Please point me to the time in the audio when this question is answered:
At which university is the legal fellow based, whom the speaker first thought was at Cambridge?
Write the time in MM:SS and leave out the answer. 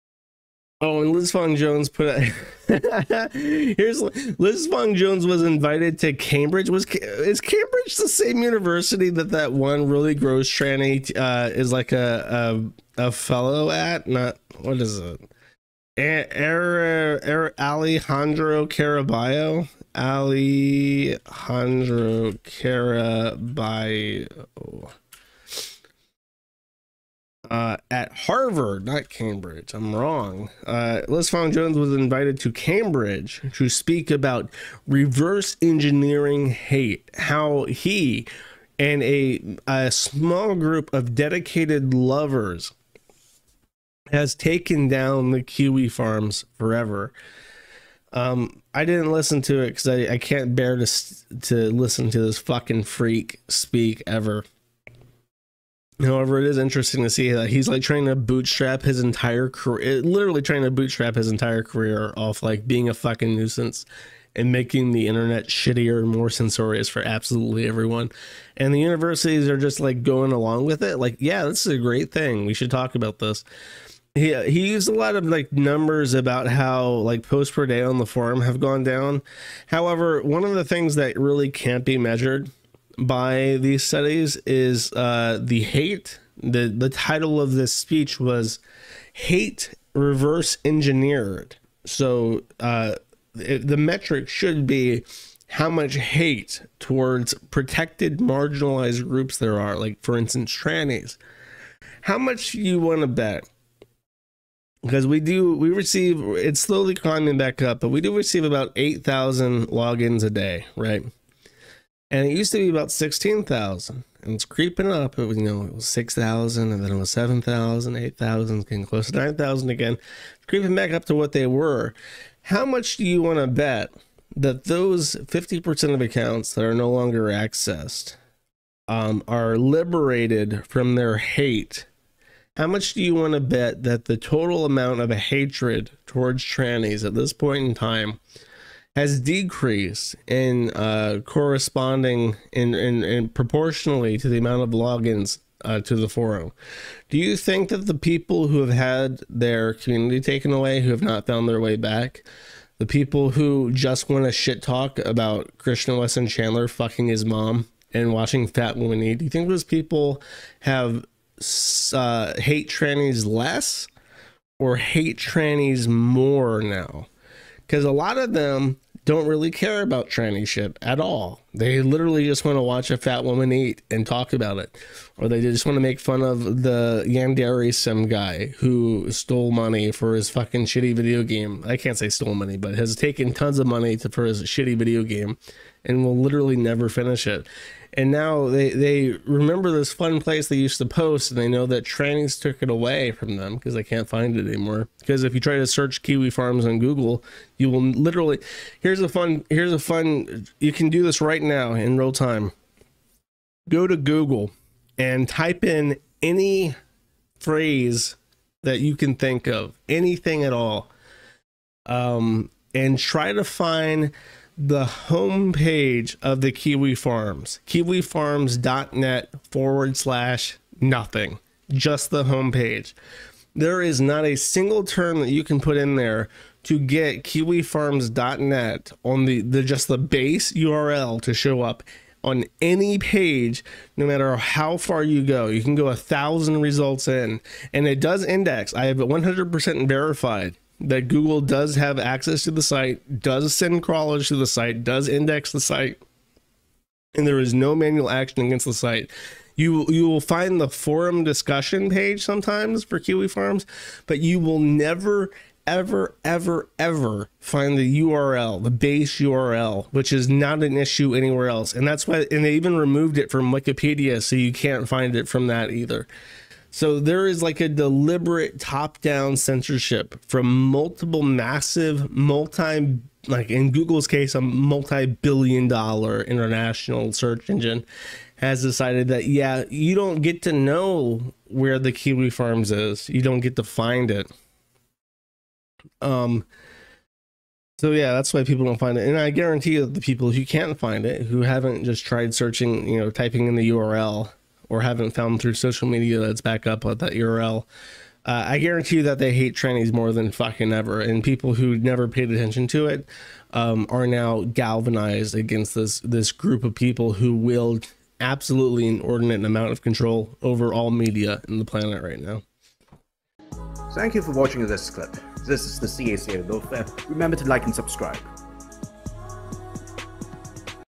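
00:28.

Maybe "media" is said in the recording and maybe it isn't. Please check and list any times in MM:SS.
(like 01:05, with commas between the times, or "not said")
04:55, 05:10.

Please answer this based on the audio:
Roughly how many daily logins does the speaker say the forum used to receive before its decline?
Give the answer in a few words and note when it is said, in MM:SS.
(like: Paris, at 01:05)
16,000, at 01:52.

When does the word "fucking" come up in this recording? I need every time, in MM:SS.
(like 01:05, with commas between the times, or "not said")
00:52, 01:02, 02:36, 03:00, 05:00.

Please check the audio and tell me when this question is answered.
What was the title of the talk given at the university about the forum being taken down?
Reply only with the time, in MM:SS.
01:29.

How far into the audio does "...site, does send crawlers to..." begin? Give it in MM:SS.
04:02.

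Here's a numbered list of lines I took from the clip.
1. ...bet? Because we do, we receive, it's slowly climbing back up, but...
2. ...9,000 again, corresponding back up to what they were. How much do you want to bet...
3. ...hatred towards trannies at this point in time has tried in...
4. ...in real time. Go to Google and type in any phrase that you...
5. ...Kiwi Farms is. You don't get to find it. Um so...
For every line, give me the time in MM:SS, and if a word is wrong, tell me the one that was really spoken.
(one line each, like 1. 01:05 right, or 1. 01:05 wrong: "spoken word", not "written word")
1. 01:43 right
2. 01:59 wrong: "creeping", not "corresponding"
3. 02:15 wrong: "decreased", not "tried"
4. 03:21 right
5. 04:41 right.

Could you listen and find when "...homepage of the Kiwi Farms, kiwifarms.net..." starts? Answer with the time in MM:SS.
03:35.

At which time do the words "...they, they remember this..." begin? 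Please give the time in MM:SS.
03:08.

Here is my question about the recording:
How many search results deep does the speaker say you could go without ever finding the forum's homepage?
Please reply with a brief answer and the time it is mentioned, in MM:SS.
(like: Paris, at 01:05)
1,000, at 03:55.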